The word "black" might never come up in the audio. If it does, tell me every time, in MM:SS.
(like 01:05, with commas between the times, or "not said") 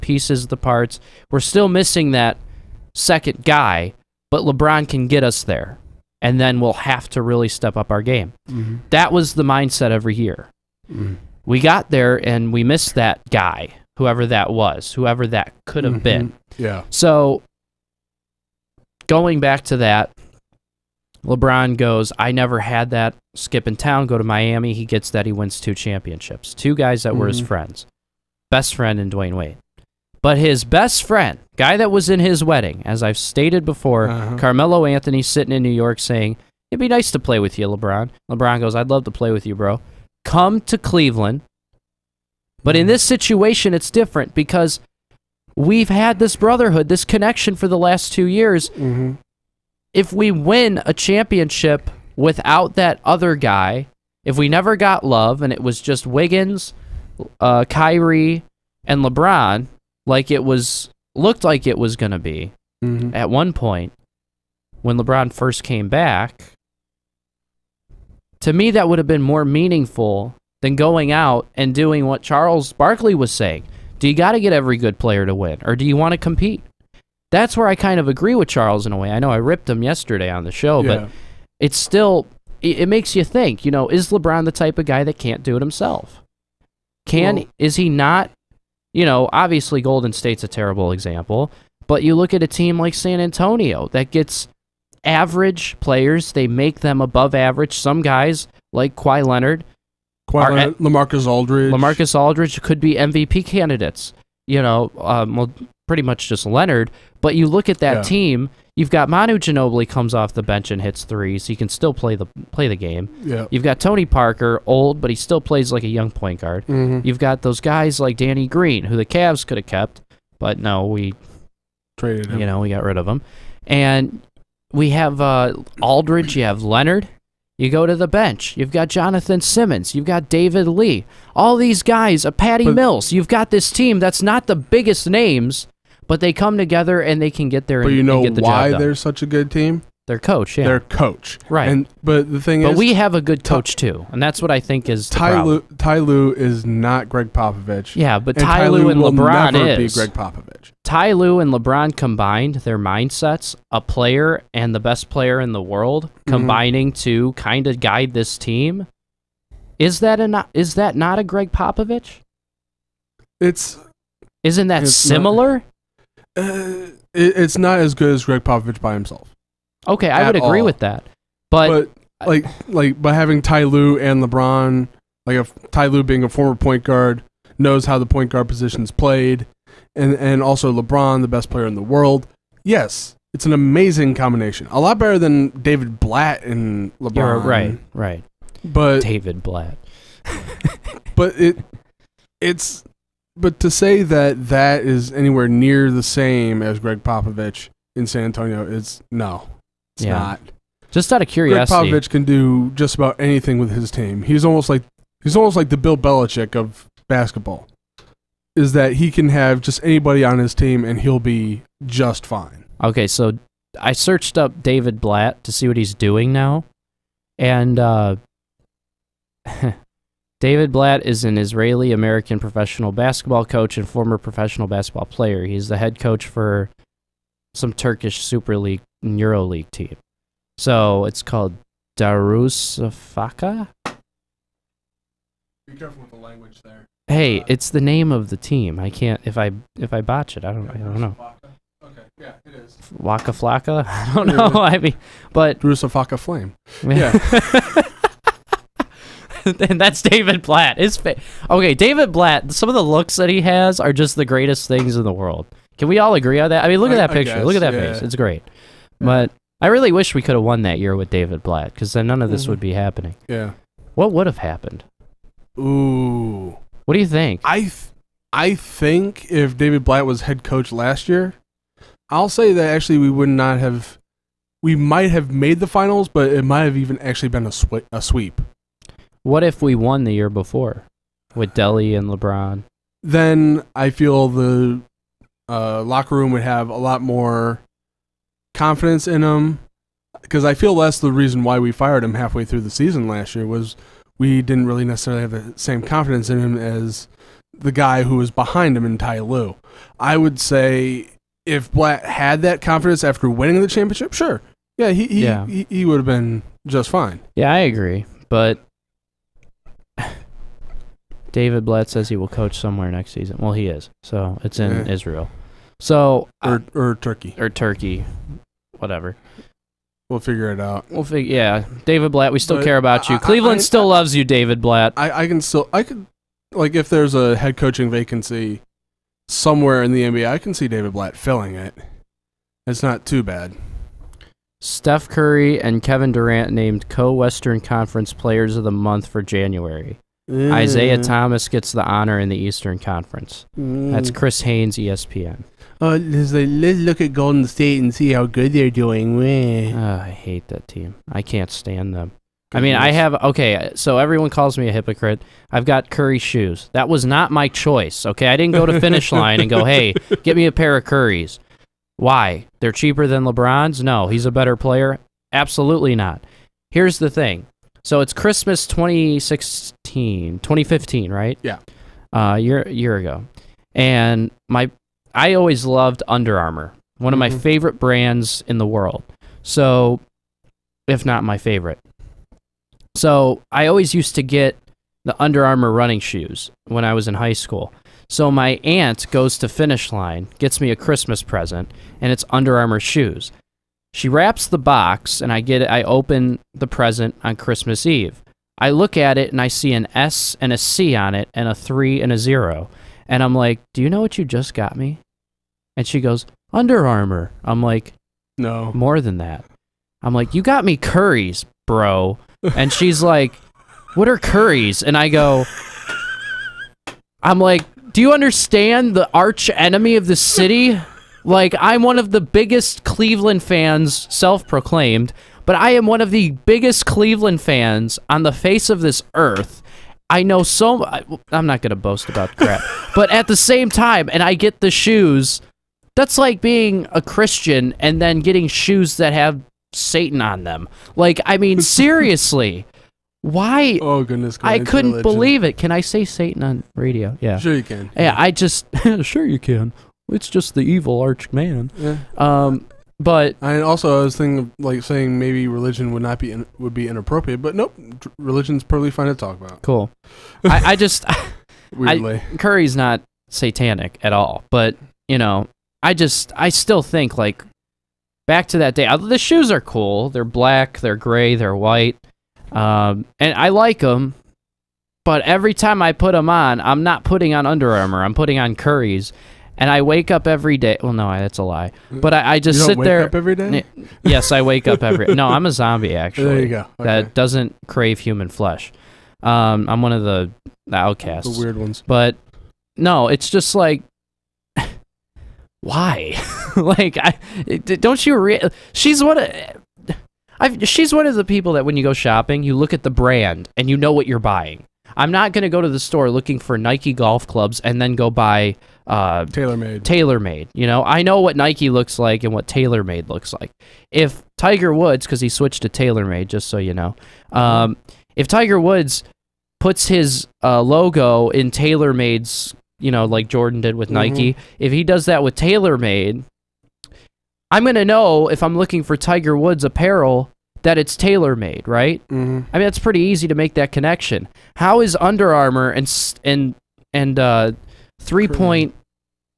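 07:50.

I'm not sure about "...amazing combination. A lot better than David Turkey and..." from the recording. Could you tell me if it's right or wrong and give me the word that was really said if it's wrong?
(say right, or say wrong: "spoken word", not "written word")
wrong: "Blatt", not "Turkey".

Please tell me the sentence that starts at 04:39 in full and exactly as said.
What if we won the year before with Delhi and LeBron?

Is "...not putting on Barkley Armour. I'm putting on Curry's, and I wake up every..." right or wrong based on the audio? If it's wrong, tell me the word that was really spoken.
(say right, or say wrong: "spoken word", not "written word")
wrong: "Under", not "Barkley".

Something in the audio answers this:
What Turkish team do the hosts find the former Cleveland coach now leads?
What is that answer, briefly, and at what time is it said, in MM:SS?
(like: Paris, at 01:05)
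Darusafaka, at 03:51.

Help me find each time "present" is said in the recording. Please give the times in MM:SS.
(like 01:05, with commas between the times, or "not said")
06:31, 06:36.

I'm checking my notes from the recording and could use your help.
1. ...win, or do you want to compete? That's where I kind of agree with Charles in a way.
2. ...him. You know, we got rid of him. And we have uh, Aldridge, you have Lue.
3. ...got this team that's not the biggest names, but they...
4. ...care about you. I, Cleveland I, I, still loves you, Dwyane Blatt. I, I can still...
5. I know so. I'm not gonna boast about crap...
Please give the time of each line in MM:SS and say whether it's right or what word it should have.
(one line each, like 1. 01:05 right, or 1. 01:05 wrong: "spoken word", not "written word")
1. 01:15 right
2. 02:02 wrong: "Leonard", not "Lue"
3. 02:13 right
4. 05:22 wrong: "David", not "Dwyane"
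5. 07:10 right.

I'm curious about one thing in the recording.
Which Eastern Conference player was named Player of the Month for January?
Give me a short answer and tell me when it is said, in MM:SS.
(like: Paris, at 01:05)
Isaiah Thomas, at 05:40.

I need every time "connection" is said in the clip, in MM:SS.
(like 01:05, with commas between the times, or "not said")
00:47, 08:53.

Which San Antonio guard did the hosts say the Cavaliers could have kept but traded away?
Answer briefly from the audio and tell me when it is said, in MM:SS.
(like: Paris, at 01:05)
Danny Green, at 01:58.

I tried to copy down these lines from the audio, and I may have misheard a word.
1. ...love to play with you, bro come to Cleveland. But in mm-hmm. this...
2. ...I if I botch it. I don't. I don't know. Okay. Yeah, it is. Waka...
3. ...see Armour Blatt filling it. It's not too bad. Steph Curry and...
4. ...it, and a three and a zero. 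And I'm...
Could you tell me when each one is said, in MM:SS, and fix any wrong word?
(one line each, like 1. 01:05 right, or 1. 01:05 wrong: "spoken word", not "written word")
1. 00:38 right
2. 03:59 right
3. 05:30 wrong: "David", not "Armour"
4. 06:41 right.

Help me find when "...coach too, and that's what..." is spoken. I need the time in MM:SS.
02:23.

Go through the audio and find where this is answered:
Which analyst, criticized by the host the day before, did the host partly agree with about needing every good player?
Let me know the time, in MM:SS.
01:12.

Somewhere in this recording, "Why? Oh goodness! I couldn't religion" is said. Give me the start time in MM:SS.
07:23.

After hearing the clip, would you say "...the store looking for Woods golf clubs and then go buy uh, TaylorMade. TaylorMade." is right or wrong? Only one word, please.
wrong.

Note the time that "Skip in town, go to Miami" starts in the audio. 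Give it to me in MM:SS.
00:23.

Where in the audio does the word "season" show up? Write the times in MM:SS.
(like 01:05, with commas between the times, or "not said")
04:52, 05:13.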